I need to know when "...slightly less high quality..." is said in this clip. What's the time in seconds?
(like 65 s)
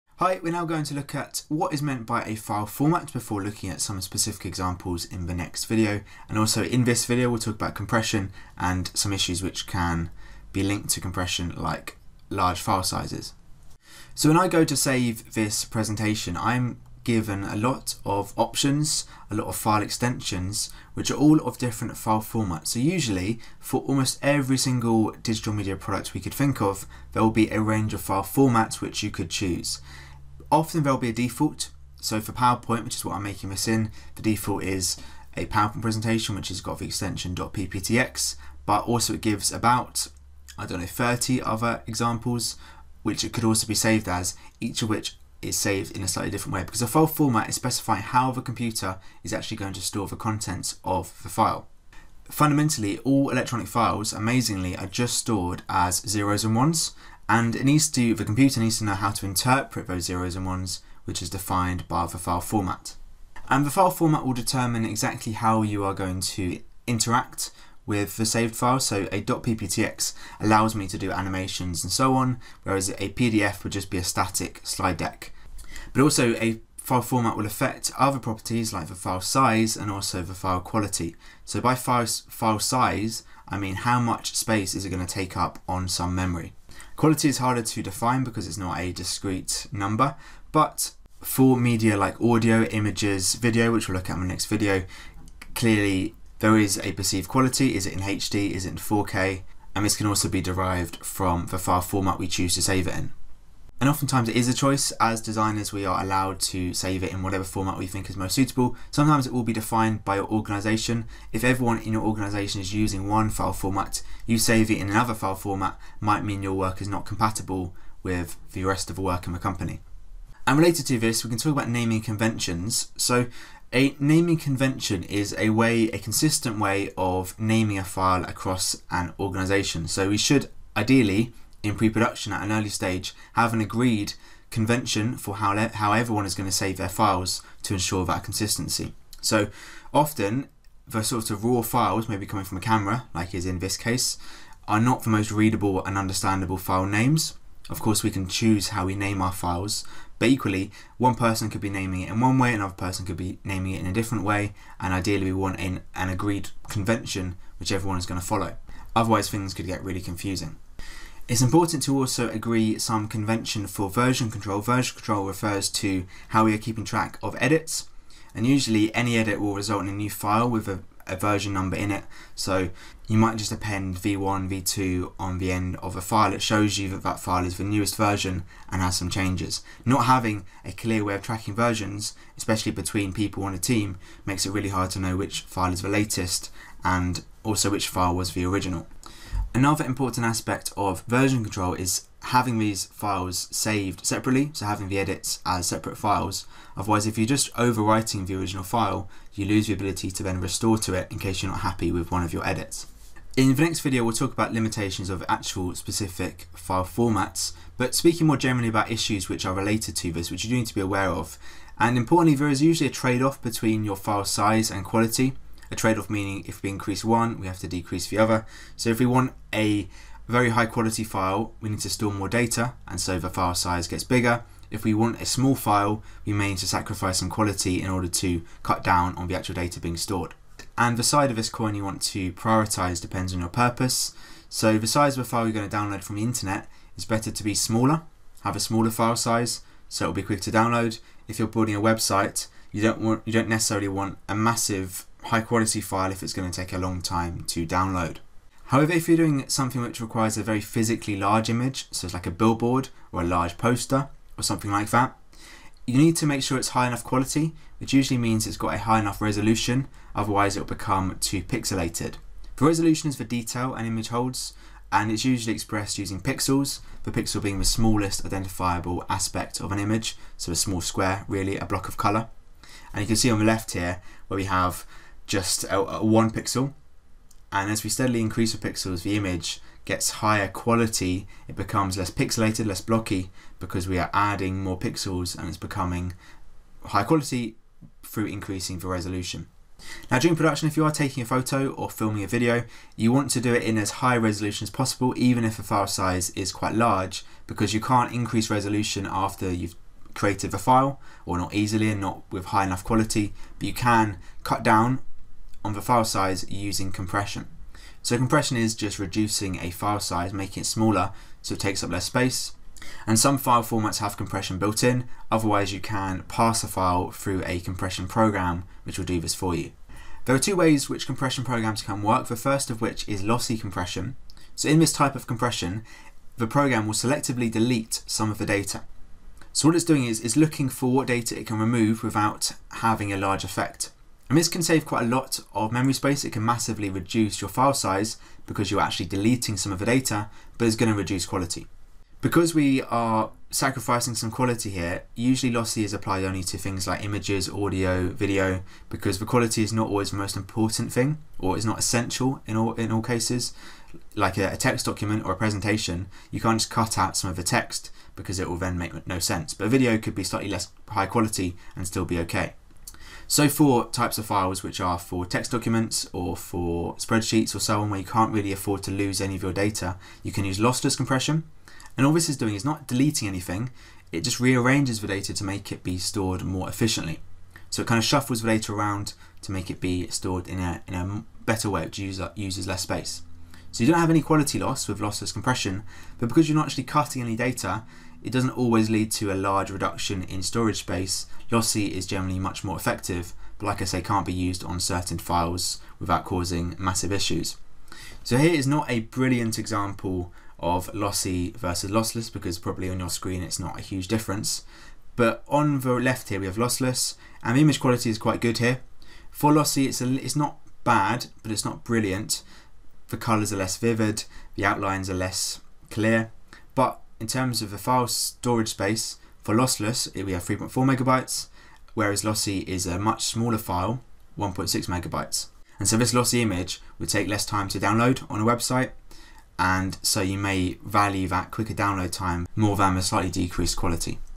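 360 s.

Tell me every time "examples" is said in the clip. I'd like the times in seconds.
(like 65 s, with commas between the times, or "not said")
4 s, 41 s, 399 s.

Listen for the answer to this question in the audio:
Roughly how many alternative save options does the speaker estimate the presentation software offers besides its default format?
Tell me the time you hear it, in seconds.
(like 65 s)
40 s.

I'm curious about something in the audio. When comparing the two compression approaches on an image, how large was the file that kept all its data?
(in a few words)
3.4 megabytes.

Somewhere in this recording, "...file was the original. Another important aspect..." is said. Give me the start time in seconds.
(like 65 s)
187 s.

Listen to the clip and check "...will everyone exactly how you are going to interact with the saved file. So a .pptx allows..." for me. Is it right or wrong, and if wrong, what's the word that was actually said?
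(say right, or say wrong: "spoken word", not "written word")
wrong: "determine", not "everyone".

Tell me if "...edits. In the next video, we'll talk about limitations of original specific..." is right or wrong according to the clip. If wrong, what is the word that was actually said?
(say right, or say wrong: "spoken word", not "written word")
wrong: "actual", not "original".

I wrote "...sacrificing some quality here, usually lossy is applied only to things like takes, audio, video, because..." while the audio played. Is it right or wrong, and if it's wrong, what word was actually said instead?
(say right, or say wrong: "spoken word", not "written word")
wrong: "images", not "takes".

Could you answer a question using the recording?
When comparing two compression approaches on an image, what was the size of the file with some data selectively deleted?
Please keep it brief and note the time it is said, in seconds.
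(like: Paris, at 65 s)
1.6 megabytes, at 424 s.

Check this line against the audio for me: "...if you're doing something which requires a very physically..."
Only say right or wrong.
right.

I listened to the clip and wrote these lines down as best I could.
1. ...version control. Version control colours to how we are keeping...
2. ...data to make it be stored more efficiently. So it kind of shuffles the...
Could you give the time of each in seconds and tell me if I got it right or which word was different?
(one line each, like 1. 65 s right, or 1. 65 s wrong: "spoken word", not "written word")
1. 163 s wrong: "refers", not "colours"
2. 375 s right.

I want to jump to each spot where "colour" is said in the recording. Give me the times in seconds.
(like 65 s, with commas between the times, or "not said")
271 s, 413 s.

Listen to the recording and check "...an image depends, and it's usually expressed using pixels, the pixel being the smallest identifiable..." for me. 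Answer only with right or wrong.
wrong.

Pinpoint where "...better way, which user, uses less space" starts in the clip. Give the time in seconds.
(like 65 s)
381 s.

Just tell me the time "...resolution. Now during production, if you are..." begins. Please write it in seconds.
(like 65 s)
288 s.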